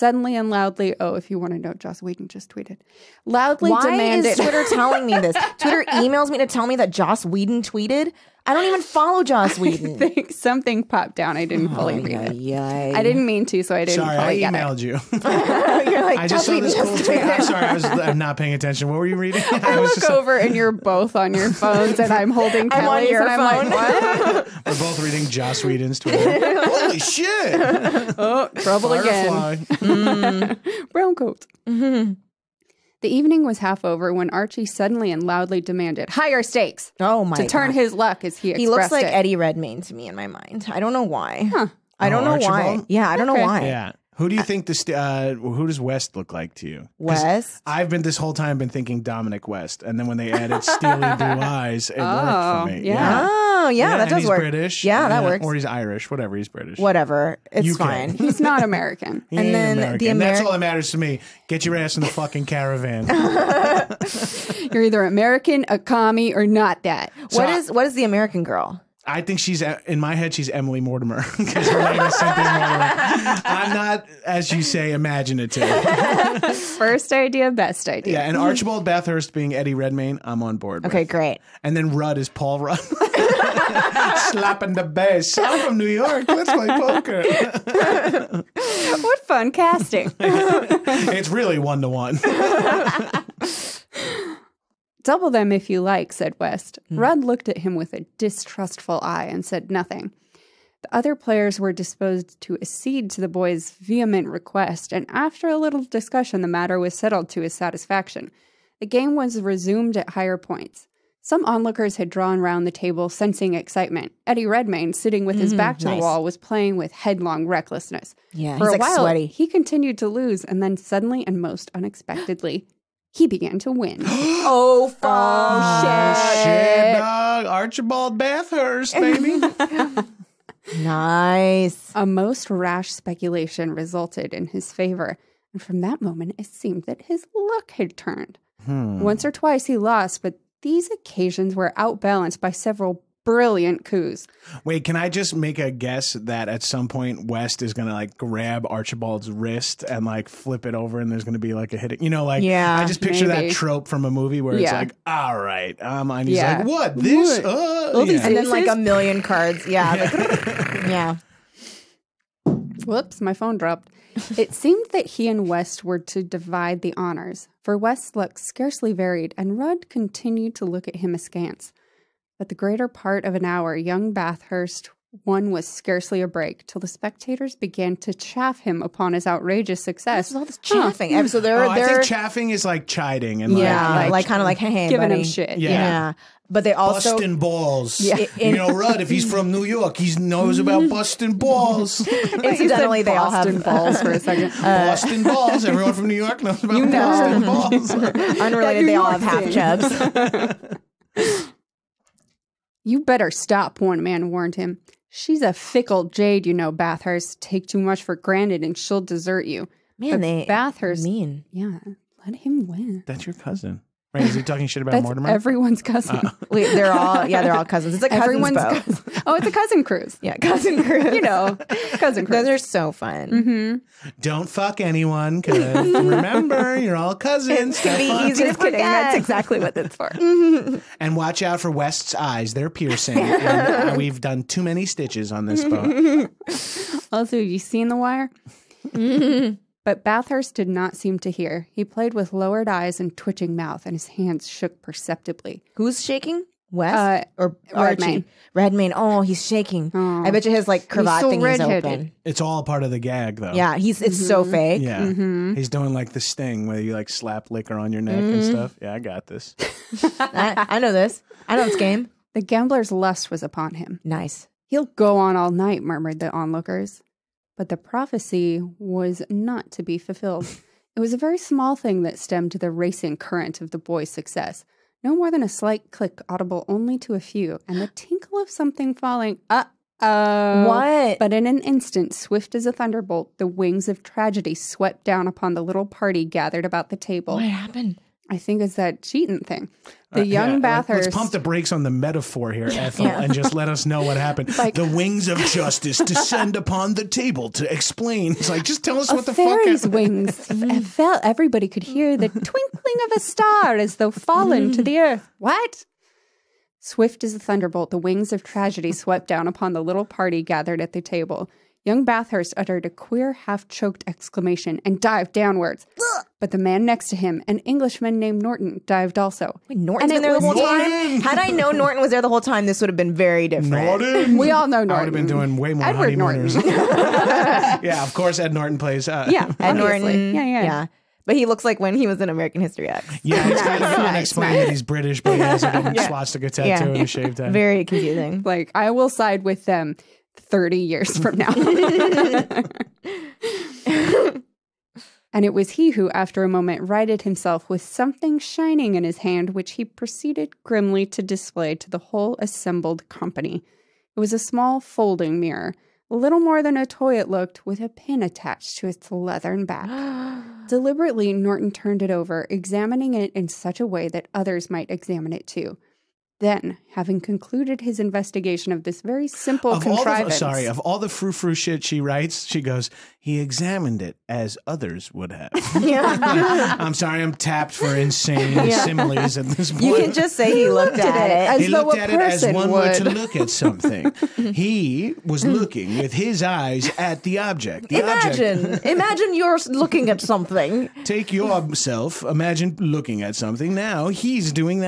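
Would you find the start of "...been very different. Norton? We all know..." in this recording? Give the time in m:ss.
5:22.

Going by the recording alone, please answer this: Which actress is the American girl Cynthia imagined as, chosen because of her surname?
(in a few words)
Emily Mortimer.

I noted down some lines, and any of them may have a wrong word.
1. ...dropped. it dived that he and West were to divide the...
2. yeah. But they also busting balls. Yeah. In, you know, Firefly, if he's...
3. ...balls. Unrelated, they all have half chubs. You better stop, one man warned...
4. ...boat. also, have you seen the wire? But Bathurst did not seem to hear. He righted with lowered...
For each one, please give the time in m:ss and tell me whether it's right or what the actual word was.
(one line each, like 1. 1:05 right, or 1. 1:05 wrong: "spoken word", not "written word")
1. 2:43 wrong: "seemed", not "dived"
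2. 3:05 wrong: "Rudd", not "Firefly"
3. 3:17 right
4. 3:55 wrong: "played", not "righted".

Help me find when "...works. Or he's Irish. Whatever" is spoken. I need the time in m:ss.
0:55.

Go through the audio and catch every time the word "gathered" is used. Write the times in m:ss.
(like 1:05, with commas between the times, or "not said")
4:46, 5:10.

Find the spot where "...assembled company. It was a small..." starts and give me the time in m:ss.
5:52.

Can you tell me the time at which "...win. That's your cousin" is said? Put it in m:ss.
3:32.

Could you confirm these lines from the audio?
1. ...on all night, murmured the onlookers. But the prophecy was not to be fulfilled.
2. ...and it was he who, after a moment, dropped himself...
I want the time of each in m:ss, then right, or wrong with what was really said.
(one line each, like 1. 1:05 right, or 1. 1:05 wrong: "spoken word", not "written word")
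1. 4:25 right
2. 5:45 wrong: "righted", not "dropped".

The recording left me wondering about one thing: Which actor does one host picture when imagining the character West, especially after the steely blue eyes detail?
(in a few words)
Dominic West.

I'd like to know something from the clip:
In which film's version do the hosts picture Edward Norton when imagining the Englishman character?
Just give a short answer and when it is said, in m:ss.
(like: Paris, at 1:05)
American History X, at 5:32.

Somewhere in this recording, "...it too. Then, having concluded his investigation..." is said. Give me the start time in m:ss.
6:05.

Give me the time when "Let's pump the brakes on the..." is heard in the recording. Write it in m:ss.
4:51.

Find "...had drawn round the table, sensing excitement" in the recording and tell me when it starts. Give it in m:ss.
1:51.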